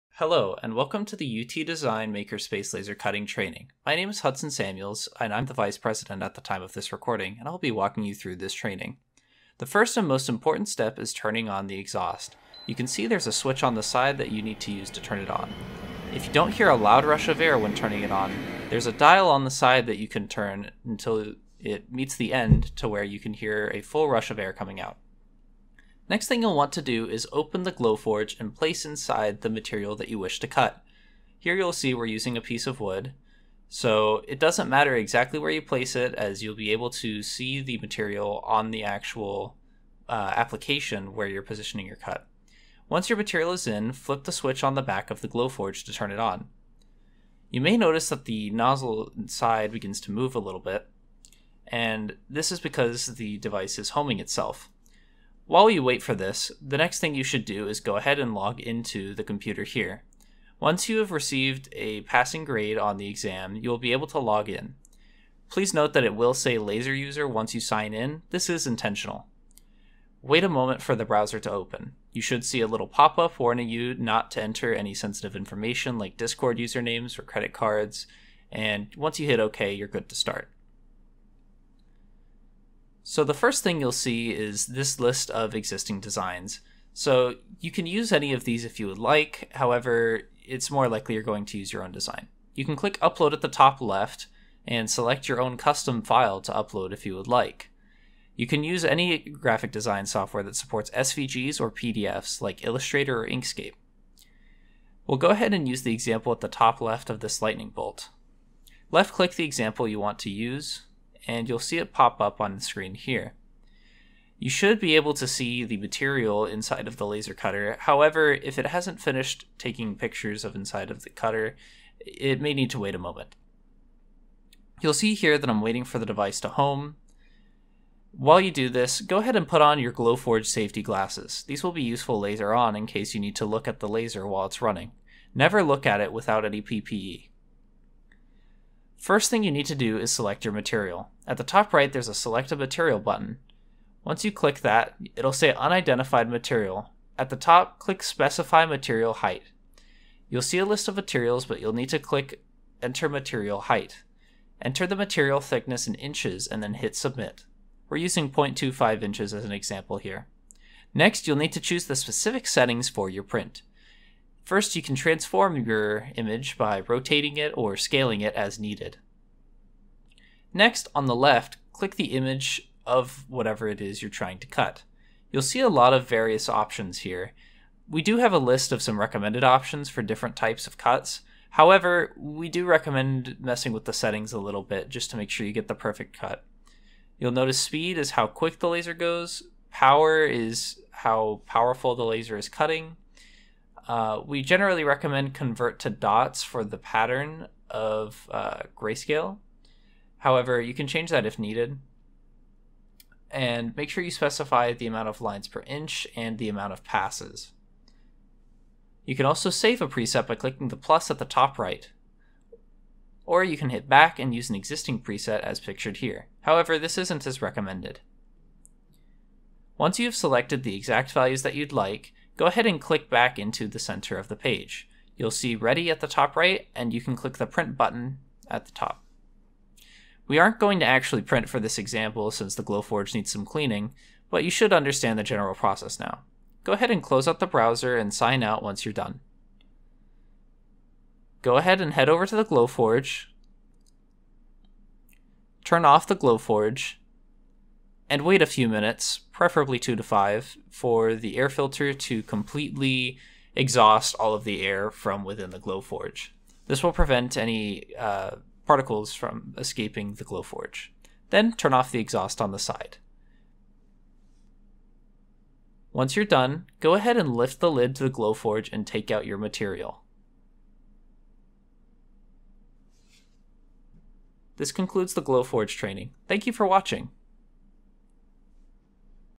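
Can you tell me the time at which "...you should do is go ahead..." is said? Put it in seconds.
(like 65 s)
57 s.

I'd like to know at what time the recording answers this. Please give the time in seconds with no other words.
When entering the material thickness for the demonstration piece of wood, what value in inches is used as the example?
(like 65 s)
158 s.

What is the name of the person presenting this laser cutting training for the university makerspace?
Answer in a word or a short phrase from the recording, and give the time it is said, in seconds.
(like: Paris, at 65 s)
Hudson Samuels, at 4 s.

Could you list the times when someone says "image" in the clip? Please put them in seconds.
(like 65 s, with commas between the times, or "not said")
166 s, 172 s.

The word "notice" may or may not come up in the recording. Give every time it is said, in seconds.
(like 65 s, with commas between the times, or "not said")
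47 s, 187 s.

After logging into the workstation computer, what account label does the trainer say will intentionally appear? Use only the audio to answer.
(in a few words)
laser user.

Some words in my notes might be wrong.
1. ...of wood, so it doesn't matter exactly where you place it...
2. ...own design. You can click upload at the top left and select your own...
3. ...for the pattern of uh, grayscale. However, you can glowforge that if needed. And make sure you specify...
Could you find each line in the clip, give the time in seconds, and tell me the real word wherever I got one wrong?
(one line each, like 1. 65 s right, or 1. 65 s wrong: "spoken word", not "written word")
1. 32 s right
2. 91 s right
3. 196 s wrong: "change", not "glowforge".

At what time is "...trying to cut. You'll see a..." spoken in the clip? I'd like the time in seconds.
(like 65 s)
174 s.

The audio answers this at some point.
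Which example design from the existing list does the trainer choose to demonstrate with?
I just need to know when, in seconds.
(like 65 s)
107 s.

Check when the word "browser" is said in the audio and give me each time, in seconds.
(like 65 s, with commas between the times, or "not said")
71 s, 237 s.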